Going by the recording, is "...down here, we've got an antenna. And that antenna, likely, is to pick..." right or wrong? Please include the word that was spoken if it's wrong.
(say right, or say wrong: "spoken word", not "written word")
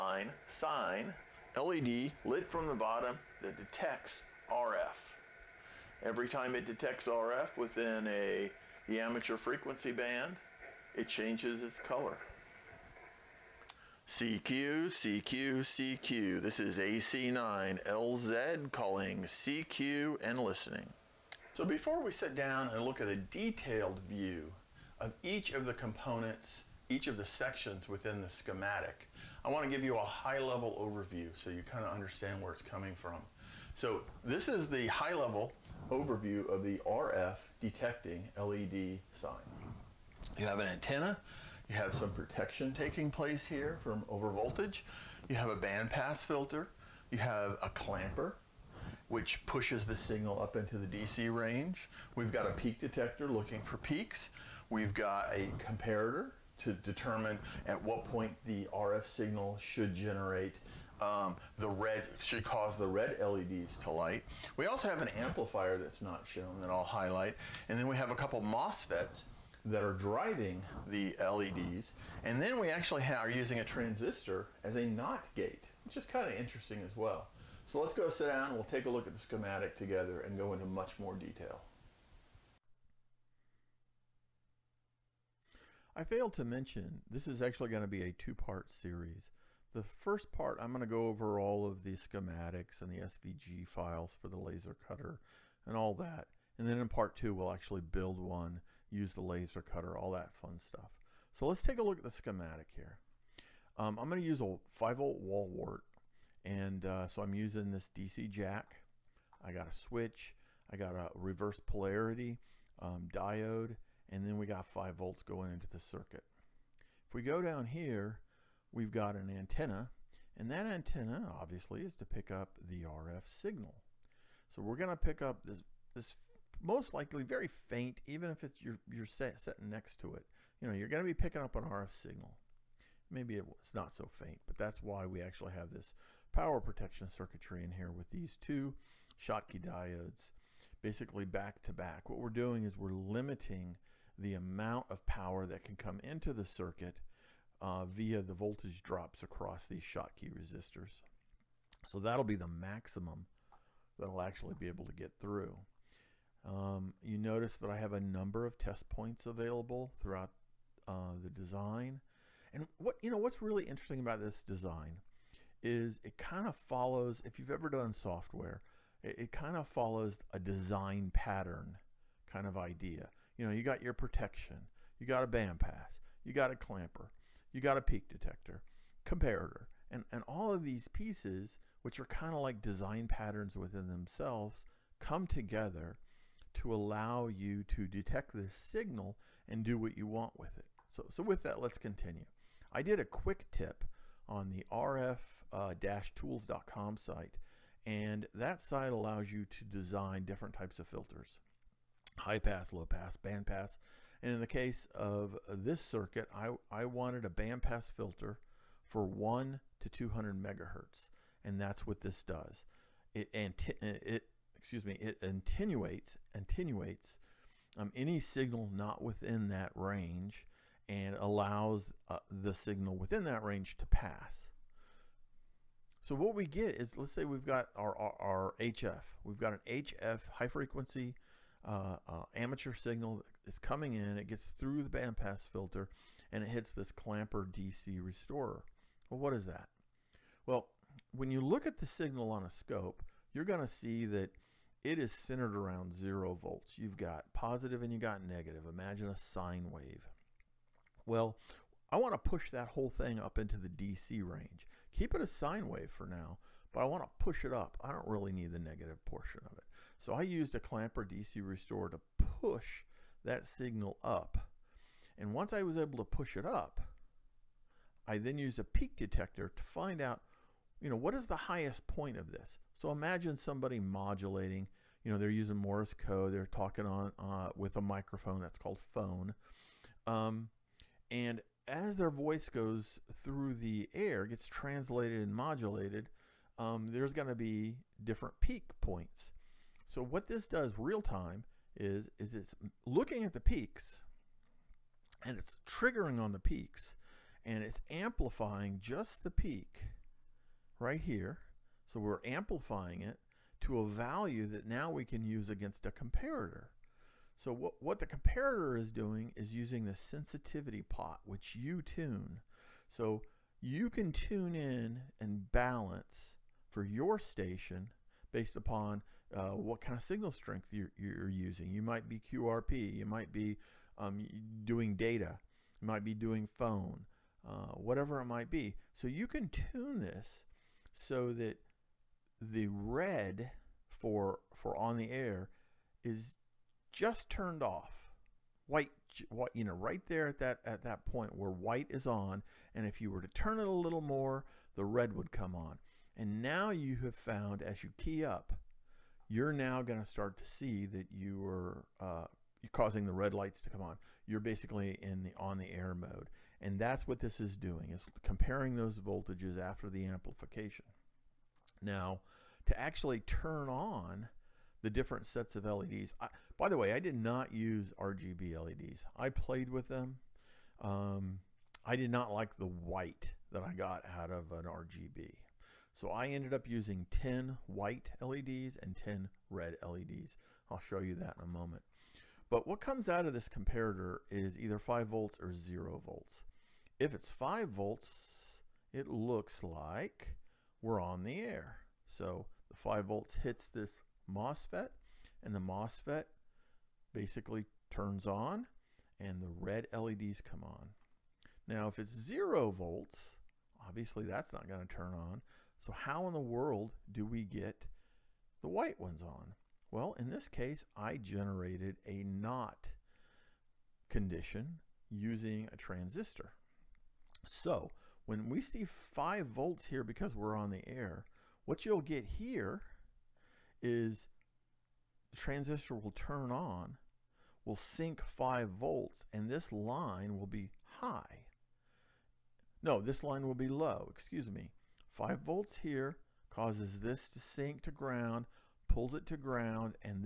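wrong: "obviously", not "likely".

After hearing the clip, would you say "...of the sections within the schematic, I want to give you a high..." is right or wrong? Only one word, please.
right.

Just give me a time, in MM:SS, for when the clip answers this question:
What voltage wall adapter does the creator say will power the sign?
01:44.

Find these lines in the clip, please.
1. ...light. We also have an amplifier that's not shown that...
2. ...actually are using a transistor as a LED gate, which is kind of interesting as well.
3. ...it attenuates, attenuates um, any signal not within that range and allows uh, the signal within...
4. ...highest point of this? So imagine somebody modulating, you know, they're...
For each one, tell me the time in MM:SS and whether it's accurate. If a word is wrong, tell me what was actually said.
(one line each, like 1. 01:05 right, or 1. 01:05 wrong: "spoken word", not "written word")
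1. 01:03 right
2. 01:12 wrong: "NOT", not "LED"
3. 03:34 right
4. 04:31 right.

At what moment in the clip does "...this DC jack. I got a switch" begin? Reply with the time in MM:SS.
01:47.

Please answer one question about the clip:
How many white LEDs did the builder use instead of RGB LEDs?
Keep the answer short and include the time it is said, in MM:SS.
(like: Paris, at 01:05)
10, at 06:17.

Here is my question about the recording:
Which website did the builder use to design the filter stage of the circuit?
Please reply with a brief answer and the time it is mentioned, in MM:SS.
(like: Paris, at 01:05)
rf-tools.com, at 03:14.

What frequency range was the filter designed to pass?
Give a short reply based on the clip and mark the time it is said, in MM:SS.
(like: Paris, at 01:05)
1 to 200 megahertz, at 03:29.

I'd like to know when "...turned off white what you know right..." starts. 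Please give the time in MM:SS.
05:37.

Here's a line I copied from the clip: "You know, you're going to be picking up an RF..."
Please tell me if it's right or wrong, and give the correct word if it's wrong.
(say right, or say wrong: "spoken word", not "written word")
right.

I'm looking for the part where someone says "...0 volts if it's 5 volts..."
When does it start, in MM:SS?
06:25.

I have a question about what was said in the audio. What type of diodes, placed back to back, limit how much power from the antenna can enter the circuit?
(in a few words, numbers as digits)
Schottky diodes.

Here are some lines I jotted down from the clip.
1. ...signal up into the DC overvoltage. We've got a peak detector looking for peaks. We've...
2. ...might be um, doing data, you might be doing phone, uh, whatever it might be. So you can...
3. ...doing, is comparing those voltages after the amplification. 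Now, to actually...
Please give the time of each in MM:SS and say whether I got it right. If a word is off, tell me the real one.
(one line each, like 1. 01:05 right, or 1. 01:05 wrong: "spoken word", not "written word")
1. 00:49 wrong: "range", not "overvoltage"
2. 05:23 right
3. 05:57 right.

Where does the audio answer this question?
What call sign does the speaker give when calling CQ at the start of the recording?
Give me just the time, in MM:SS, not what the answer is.
00:16.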